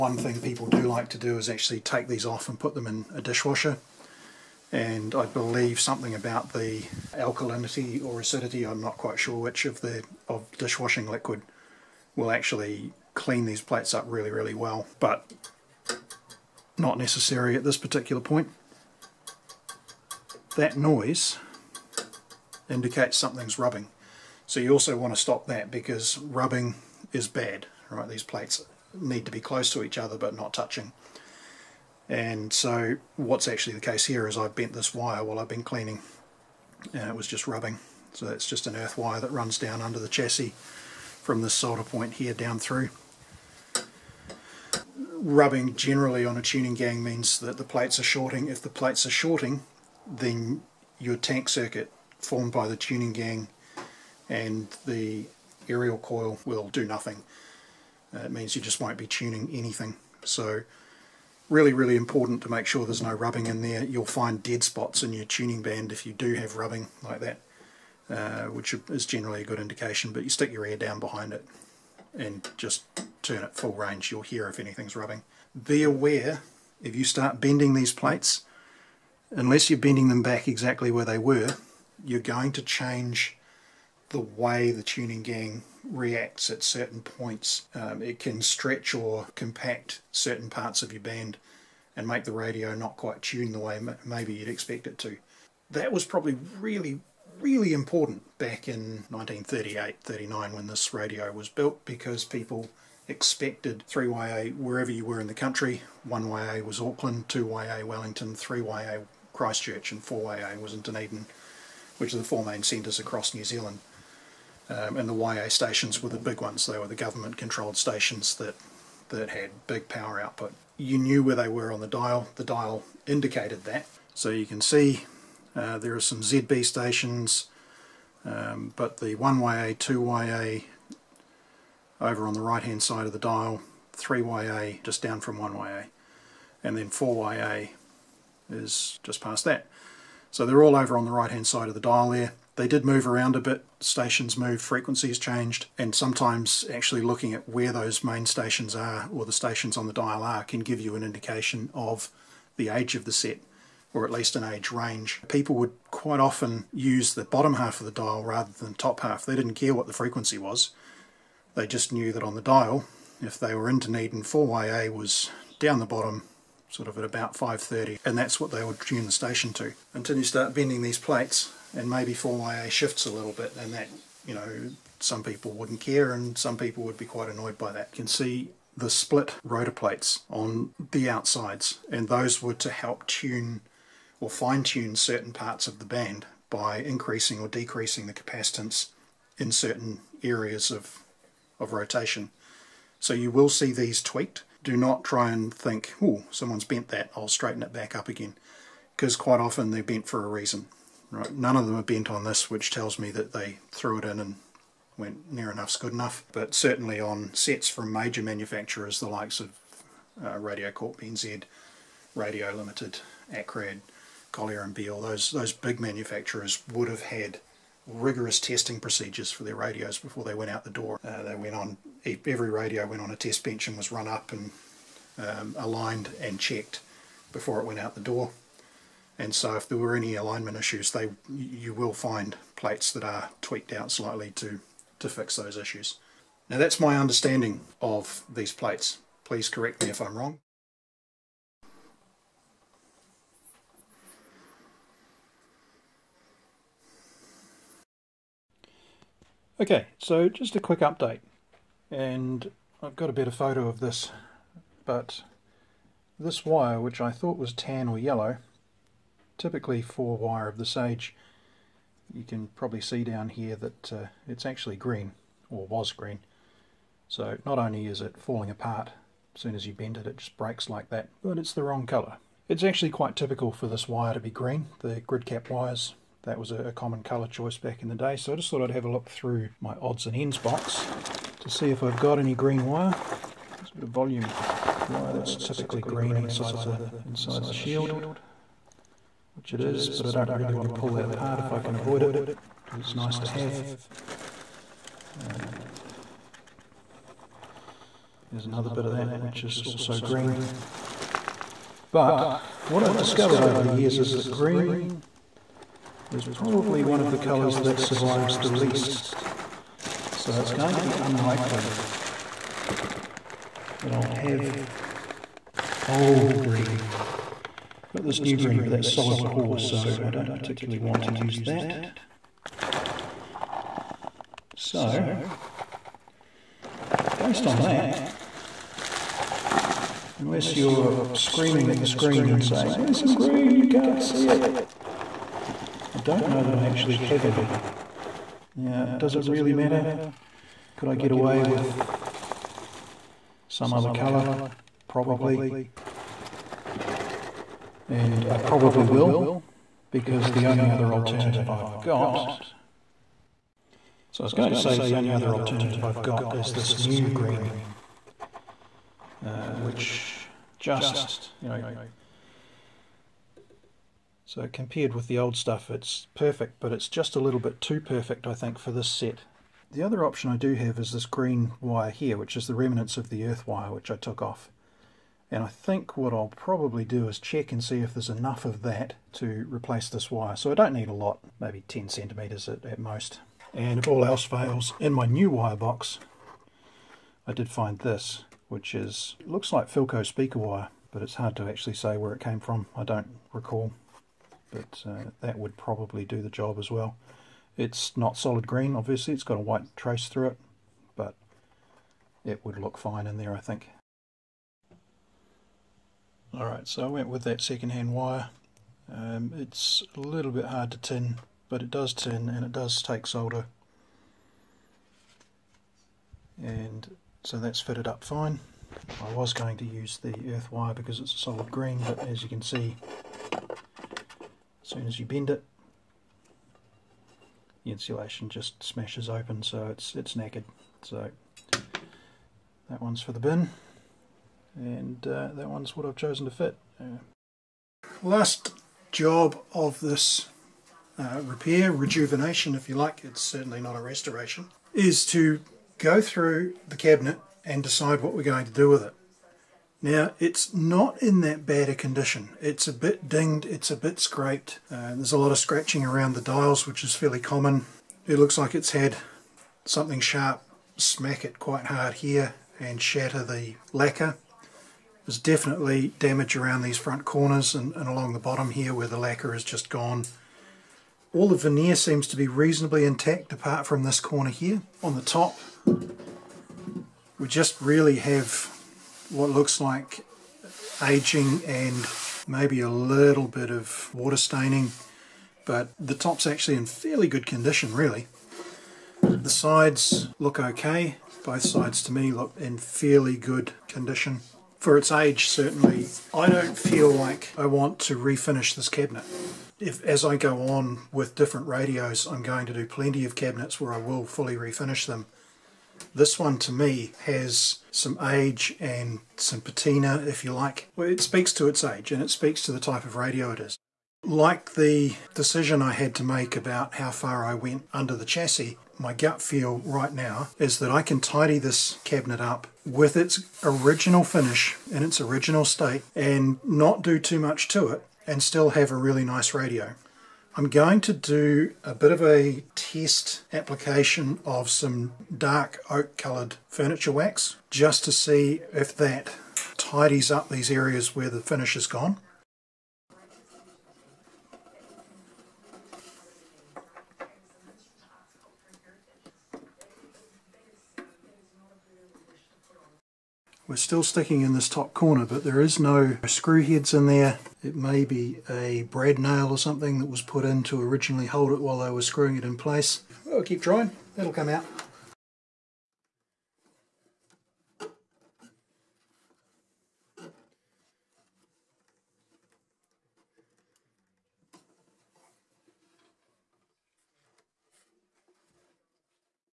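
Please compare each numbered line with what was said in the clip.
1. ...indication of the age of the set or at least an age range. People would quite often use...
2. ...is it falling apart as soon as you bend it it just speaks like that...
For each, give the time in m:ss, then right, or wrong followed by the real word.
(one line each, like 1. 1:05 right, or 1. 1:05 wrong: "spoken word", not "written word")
1. 2:31 right
2. 4:27 wrong: "breaks", not "speaks".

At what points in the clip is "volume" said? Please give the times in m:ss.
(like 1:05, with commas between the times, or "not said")
4:43.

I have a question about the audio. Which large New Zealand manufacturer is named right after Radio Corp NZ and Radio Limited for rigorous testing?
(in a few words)
Akrad.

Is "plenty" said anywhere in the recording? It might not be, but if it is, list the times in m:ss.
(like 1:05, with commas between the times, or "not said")
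8:22.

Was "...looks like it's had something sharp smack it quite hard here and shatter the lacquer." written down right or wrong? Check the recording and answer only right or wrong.
right.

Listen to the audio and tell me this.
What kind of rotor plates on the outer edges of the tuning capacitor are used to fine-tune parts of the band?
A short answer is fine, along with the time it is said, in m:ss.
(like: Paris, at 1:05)
split rotor plates, at 2:58.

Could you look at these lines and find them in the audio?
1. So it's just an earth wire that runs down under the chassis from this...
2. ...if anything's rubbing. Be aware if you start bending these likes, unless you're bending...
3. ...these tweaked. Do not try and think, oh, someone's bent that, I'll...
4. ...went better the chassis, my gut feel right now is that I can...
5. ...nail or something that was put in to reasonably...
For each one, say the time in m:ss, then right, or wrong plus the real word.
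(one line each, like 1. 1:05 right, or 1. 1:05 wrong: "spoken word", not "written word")
1. 0:38 right
2. 1:14 wrong: "plates", not "likes"
3. 3:13 right
4. 8:37 wrong: "under", not "better"
5. 9:18 wrong: "originally", not "reasonably".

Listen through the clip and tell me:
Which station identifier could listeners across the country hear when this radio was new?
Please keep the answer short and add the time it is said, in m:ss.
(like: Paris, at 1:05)
3YA, at 1:43.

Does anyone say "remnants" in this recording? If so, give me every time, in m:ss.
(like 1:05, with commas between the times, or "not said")
6:12.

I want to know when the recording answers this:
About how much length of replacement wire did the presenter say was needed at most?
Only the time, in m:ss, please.
6:21.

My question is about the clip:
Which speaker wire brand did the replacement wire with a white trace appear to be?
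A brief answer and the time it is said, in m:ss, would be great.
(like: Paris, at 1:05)
Philco, at 6:29.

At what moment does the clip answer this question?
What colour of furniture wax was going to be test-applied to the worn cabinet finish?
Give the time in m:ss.
8:55.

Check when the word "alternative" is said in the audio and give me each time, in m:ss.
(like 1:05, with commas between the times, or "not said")
5:50, 5:55.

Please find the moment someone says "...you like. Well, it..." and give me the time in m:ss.
8:30.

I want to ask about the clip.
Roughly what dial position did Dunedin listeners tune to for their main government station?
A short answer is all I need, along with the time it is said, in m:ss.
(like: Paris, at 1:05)
5.30, at 2:47.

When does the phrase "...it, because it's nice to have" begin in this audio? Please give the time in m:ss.
4:52.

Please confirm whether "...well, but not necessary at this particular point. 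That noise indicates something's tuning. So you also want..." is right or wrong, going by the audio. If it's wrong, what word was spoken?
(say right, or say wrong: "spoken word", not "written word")
wrong: "rubbing", not "tuning".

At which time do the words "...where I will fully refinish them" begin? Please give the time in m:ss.
8:23.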